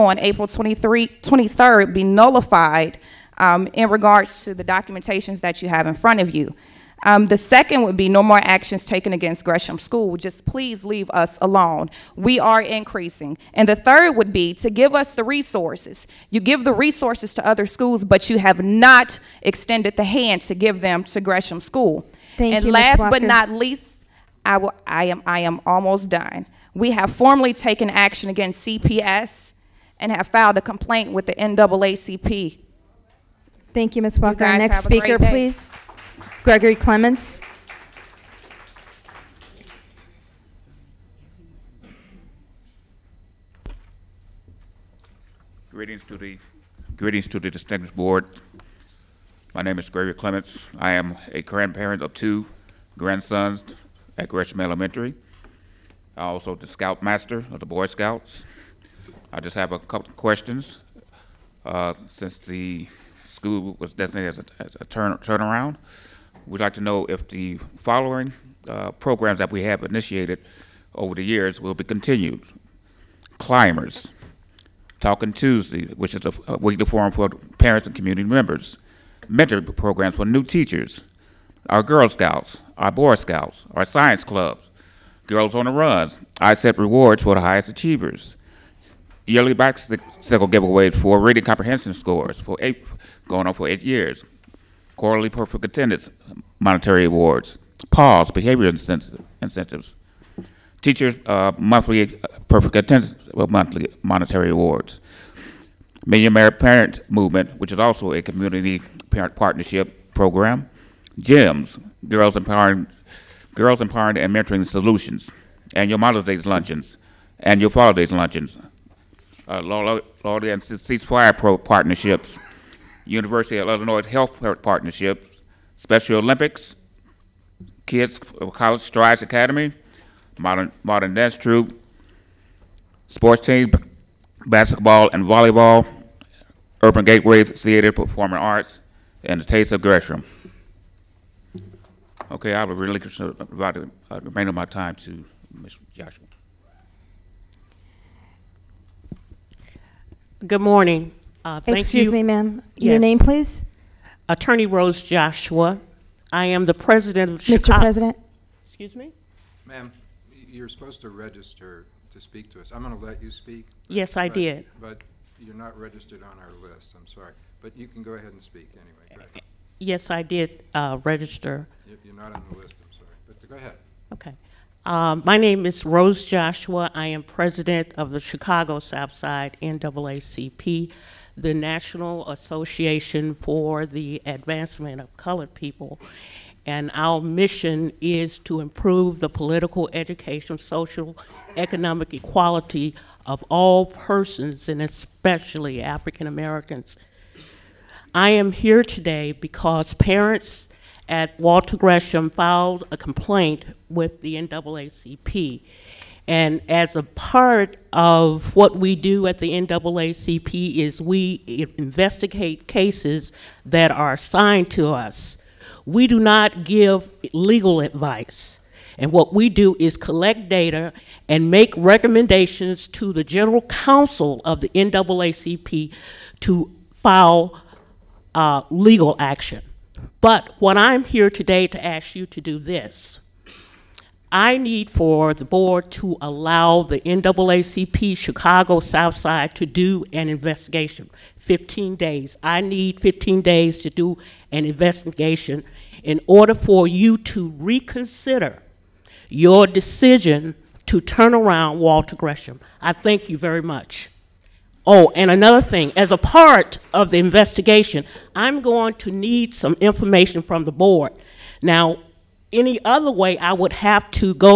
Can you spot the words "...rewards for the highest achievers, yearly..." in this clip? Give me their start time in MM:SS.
01:26.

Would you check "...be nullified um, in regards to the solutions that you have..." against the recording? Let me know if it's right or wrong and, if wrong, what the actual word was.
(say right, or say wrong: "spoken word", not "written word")
wrong: "documentations", not "solutions".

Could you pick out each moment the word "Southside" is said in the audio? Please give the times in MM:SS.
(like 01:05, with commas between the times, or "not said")
02:58, 03:58.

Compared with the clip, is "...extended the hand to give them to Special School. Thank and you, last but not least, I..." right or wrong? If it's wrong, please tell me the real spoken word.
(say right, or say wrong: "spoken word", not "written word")
wrong: "Gresham", not "Special".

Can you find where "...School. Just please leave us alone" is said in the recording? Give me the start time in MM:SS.
00:09.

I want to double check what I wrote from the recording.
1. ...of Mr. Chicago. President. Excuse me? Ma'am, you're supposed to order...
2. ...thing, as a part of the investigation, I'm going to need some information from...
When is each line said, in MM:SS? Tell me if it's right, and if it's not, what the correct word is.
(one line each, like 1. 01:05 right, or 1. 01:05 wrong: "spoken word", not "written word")
1. 02:37 wrong: "register", not "order"
2. 04:15 right.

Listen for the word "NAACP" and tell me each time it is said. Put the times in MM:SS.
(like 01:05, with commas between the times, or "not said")
00:31, 02:59, 03:24, 03:29, 03:44, 03:57.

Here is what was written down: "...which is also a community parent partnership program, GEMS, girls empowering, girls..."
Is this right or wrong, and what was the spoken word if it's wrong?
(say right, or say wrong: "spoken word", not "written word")
right.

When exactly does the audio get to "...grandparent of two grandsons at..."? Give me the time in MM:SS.
00:51.